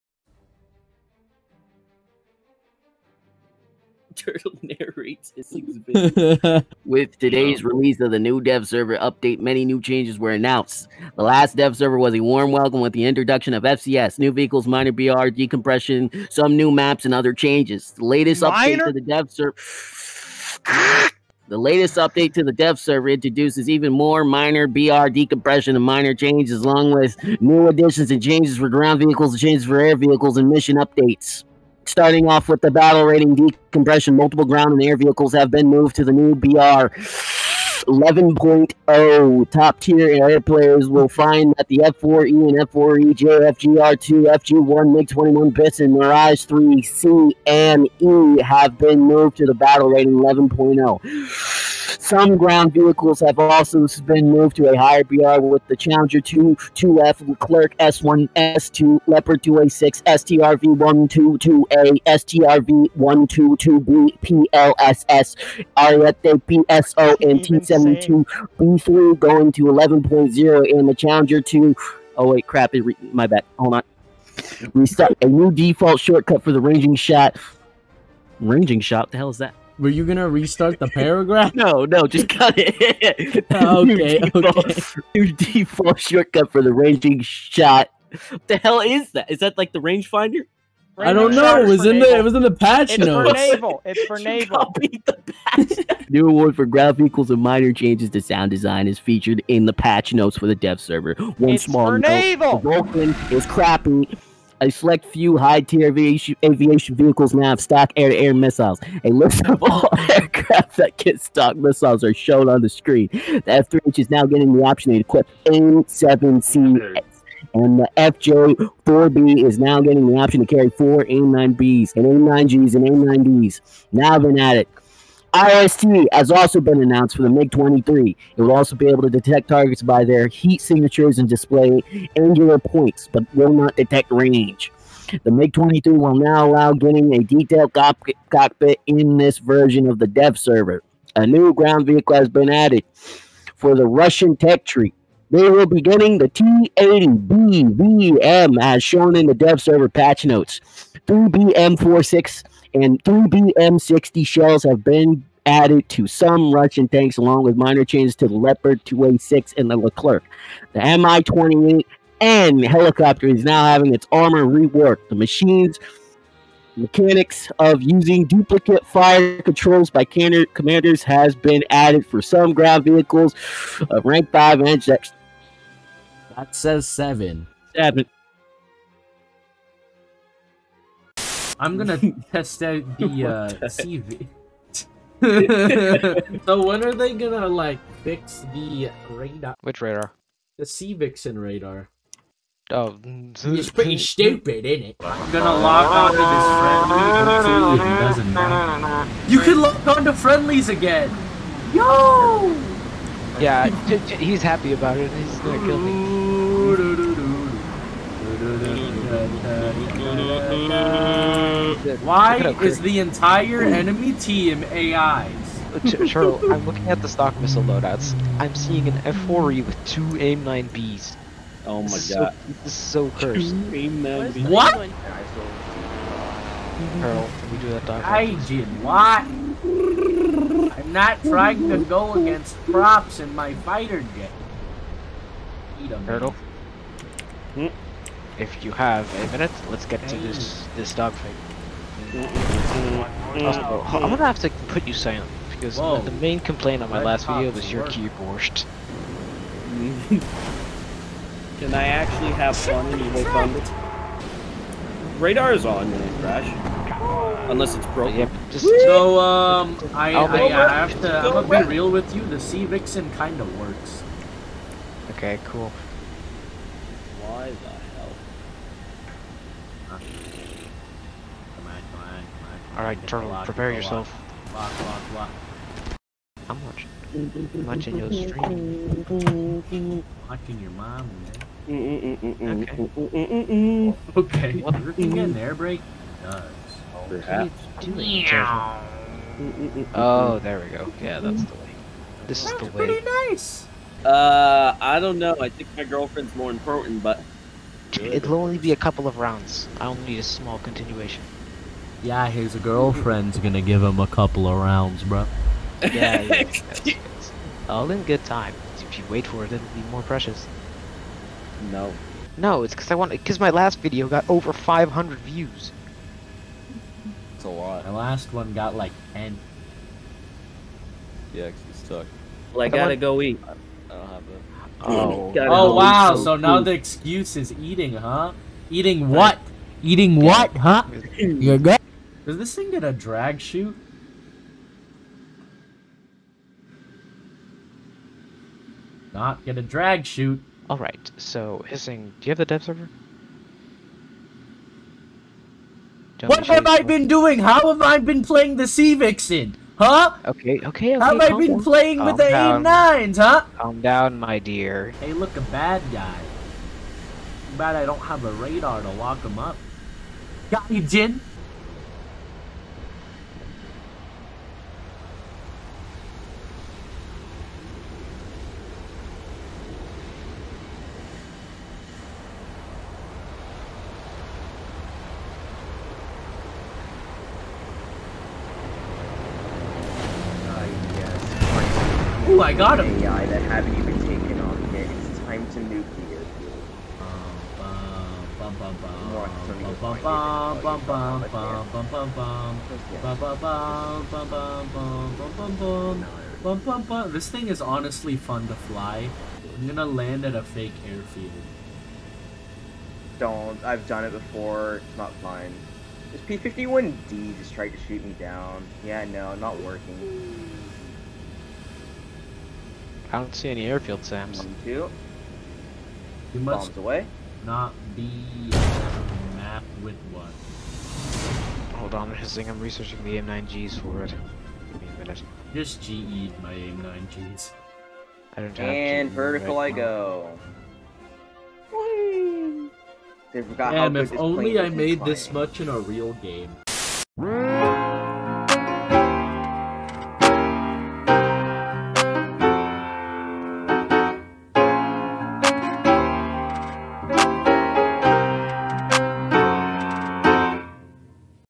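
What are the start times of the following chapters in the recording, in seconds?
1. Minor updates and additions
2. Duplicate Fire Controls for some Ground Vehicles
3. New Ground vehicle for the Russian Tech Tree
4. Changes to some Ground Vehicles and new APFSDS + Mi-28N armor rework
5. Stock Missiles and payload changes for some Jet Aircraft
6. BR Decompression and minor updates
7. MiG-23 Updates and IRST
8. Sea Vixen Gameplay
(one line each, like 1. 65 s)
1. 76 s
2. 165 s
3. 141 s
4. 151 s
5. 104 s
6. 32 s
7. 125 s
8. 182 s.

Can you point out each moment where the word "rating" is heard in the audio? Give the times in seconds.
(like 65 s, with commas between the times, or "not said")
33 s, 49 s.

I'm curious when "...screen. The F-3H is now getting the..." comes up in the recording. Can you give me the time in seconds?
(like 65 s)
112 s.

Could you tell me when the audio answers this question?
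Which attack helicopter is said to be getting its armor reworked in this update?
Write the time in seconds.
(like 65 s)
160 s.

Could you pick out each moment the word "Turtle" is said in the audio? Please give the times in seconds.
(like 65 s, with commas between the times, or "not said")
4 s, 236 s, 273 s.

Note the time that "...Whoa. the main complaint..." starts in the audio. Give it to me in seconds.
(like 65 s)
245 s.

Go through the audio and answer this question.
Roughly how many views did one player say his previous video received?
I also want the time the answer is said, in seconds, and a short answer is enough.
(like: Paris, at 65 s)
over 500, at 314 s.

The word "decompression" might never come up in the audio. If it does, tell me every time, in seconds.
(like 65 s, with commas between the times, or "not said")
15 s, 25 s, 33 s.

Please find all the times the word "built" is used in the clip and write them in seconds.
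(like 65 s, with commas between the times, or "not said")
not said.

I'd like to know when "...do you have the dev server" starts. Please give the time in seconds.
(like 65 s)
342 s.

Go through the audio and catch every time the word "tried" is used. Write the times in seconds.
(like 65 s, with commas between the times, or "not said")
407 s.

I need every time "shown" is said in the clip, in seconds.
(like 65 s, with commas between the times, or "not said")
112 s, 148 s.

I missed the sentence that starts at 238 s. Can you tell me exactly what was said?
if you have a minute, let's get to this this dogfight.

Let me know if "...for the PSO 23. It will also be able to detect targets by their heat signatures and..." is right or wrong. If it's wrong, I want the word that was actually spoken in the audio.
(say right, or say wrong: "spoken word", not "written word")
wrong: "MiG", not "PSO".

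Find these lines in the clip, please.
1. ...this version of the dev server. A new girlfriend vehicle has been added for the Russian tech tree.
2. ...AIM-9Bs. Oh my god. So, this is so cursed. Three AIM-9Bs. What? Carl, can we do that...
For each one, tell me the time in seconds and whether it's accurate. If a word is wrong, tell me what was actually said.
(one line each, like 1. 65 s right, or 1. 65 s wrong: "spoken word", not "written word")
1. 139 s wrong: "ground", not "girlfriend"
2. 220 s wrong: "Two", not "Three".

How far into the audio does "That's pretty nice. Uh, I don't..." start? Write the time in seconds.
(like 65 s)
292 s.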